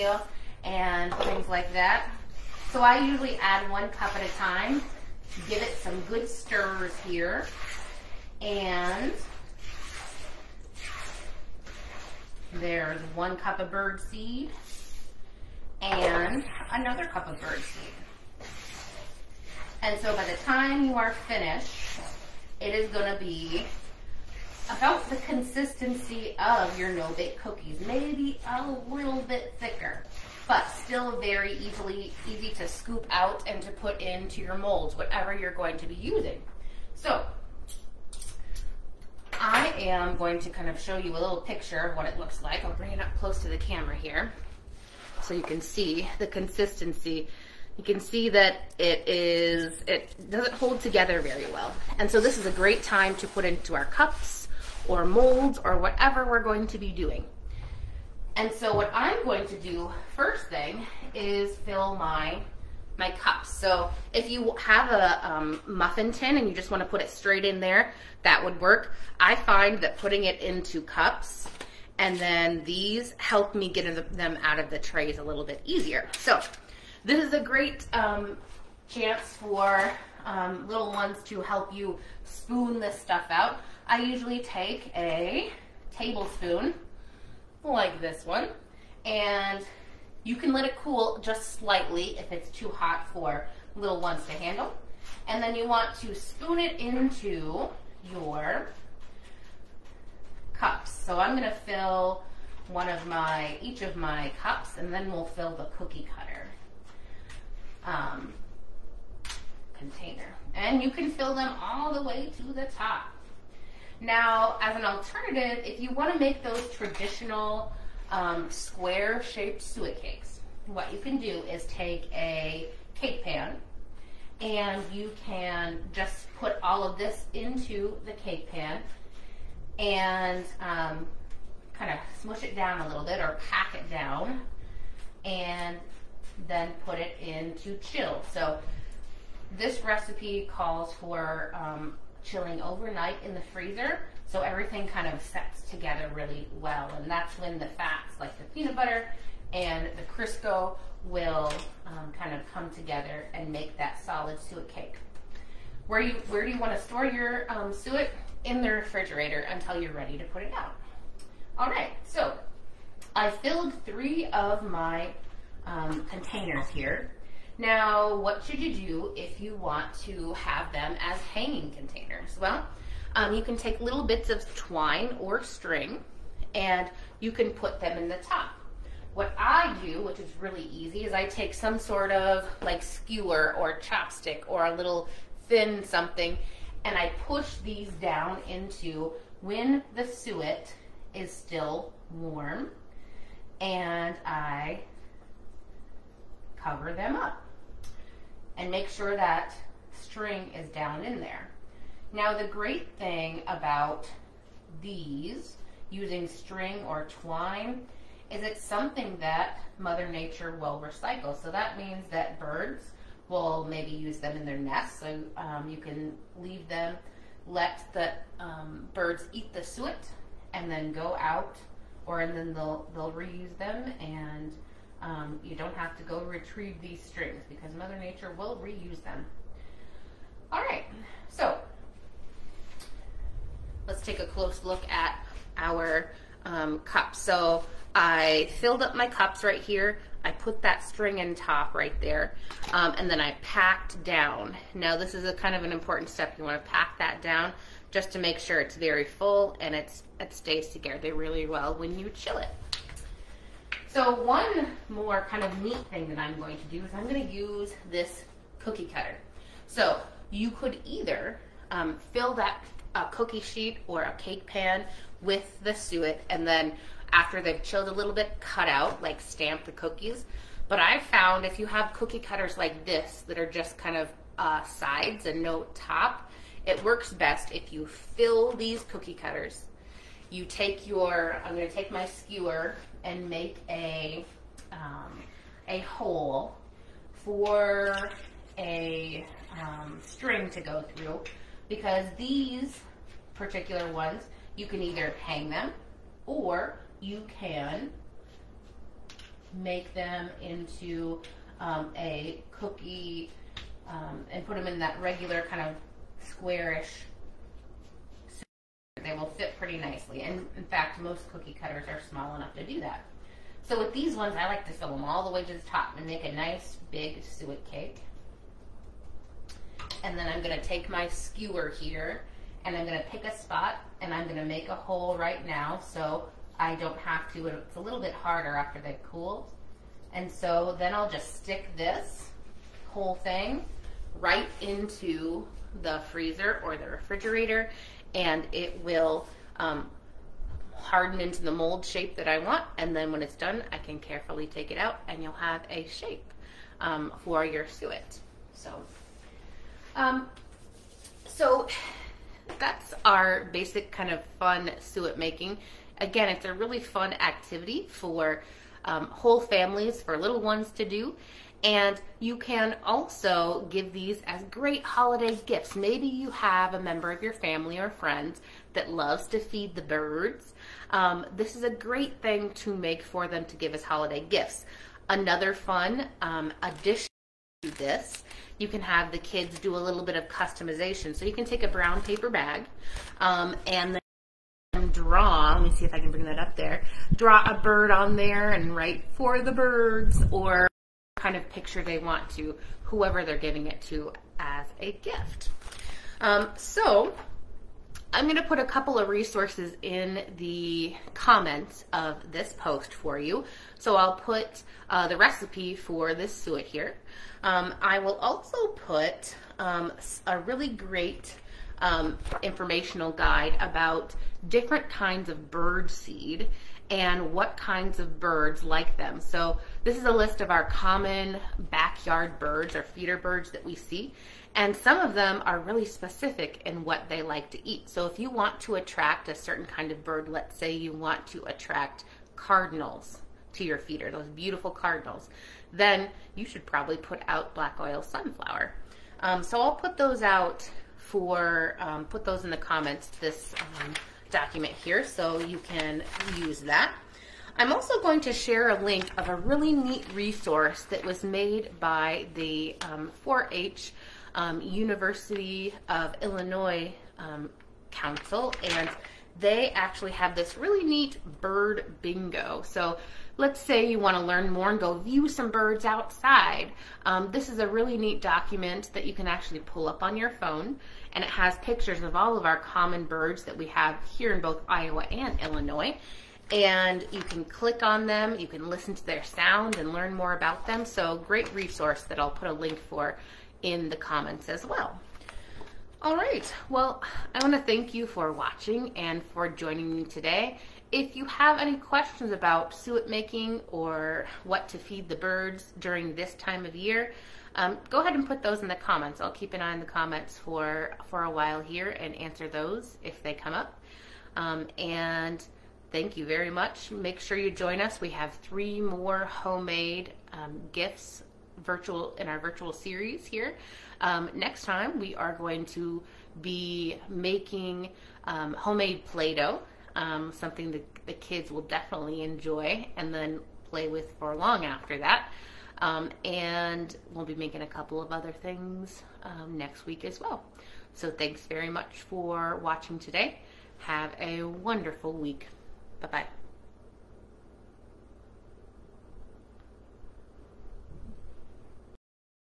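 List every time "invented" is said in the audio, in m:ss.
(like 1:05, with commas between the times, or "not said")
not said.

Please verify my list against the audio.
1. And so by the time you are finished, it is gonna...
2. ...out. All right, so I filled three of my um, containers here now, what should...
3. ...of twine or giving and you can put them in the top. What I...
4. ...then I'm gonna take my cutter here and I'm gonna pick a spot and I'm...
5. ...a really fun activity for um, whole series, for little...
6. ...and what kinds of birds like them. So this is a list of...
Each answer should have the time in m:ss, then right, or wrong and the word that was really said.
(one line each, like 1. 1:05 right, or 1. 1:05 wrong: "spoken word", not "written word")
1. 0:19 right
2. 2:40 right
3. 2:54 wrong: "string", not "giving"
4. 5:20 wrong: "skewer", not "cutter"
5. 5:56 wrong: "families", not "series"
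6. 6:56 right.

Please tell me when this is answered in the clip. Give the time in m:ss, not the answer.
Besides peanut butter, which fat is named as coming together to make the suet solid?
2:30.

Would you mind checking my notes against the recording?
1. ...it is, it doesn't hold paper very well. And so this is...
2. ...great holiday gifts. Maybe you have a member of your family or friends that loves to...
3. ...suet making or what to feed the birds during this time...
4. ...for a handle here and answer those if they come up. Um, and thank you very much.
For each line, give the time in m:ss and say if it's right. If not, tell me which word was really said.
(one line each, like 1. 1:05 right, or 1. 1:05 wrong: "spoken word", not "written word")
1. 0:48 wrong: "together", not "paper"
2. 6:04 right
3. 8:12 right
4. 8:21 wrong: "while", not "handle".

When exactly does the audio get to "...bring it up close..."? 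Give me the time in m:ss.
0:42.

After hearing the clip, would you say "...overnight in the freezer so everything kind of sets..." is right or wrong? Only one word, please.
right.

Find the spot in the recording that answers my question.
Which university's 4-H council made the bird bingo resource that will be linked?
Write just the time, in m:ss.
7:34.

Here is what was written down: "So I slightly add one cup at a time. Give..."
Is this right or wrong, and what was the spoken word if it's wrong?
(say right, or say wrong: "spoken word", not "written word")
wrong: "usually", not "slightly".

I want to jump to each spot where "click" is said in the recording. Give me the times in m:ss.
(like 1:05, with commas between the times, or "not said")
7:57.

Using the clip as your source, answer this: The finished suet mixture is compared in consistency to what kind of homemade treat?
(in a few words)
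no-bake cookies.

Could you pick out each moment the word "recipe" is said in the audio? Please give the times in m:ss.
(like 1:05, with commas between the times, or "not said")
2:19, 6:45.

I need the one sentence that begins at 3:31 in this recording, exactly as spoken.
So that means that birds will maybe use them in their nests.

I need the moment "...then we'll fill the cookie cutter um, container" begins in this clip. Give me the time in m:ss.
1:44.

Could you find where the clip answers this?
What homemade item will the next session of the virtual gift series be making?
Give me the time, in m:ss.
8:39.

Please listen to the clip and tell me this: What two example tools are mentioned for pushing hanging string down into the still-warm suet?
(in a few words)
skewer or chopstick.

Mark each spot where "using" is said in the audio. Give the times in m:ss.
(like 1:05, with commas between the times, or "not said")
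0:35, 3:25.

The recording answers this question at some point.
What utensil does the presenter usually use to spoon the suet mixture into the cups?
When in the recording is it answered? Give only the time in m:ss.
1:25.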